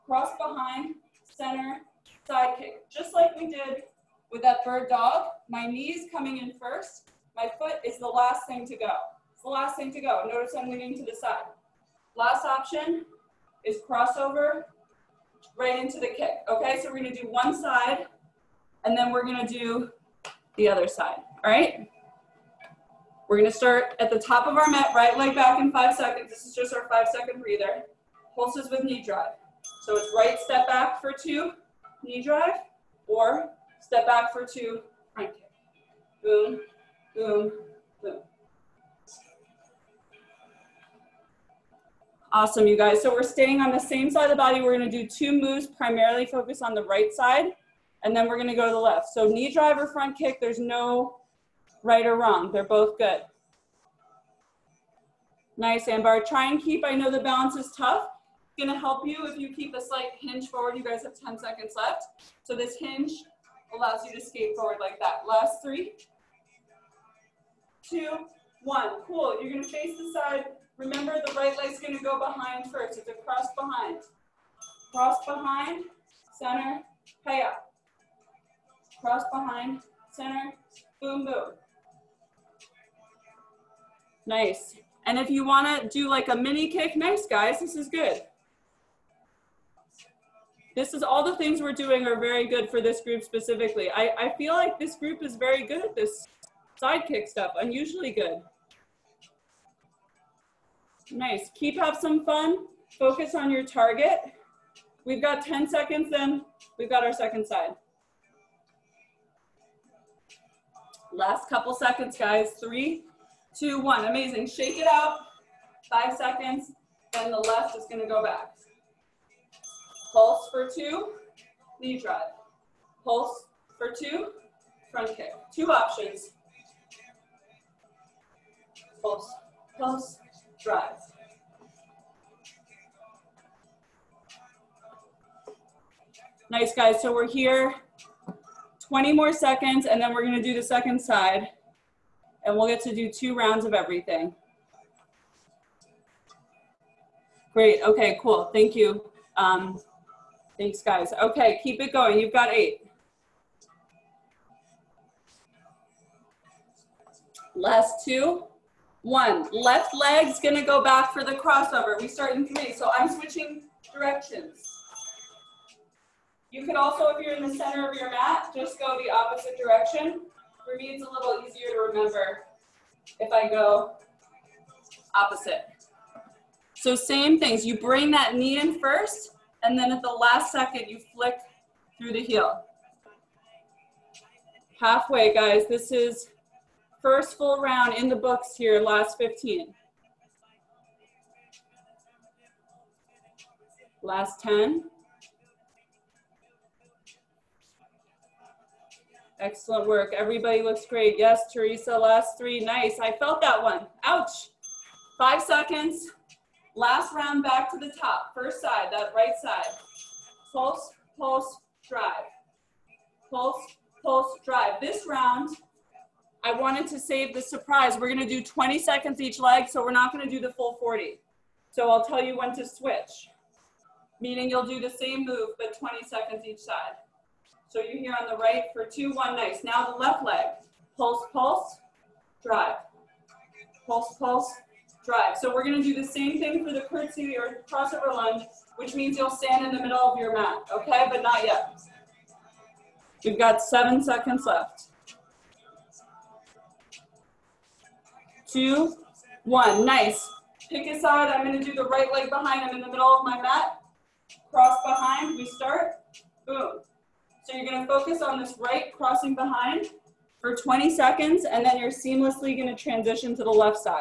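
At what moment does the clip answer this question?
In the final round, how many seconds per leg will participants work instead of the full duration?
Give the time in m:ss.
3:38.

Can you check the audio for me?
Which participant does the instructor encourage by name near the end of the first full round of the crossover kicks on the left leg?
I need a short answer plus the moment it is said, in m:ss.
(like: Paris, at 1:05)
Teresa, at 3:21.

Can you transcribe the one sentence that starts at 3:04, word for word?
Halfway, guys, this is first full round in the books here, last 15.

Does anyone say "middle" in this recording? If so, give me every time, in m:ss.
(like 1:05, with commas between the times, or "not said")
3:59, 4:12.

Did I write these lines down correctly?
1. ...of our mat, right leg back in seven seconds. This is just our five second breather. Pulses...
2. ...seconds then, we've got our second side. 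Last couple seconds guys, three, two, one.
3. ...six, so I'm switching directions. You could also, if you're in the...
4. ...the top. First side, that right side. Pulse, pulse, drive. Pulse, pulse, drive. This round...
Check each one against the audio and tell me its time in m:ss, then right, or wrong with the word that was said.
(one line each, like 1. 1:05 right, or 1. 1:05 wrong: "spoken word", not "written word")
1. 0:24 wrong: "five", not "seven"
2. 1:45 right
3. 2:42 wrong: "three", not "six"
4. 3:27 right.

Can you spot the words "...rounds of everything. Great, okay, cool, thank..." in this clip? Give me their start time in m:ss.
2:23.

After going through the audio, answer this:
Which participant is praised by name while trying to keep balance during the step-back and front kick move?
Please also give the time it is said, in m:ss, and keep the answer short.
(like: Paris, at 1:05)
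Ambar, at 0:55.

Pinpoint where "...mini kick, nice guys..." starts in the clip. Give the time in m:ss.
1:26.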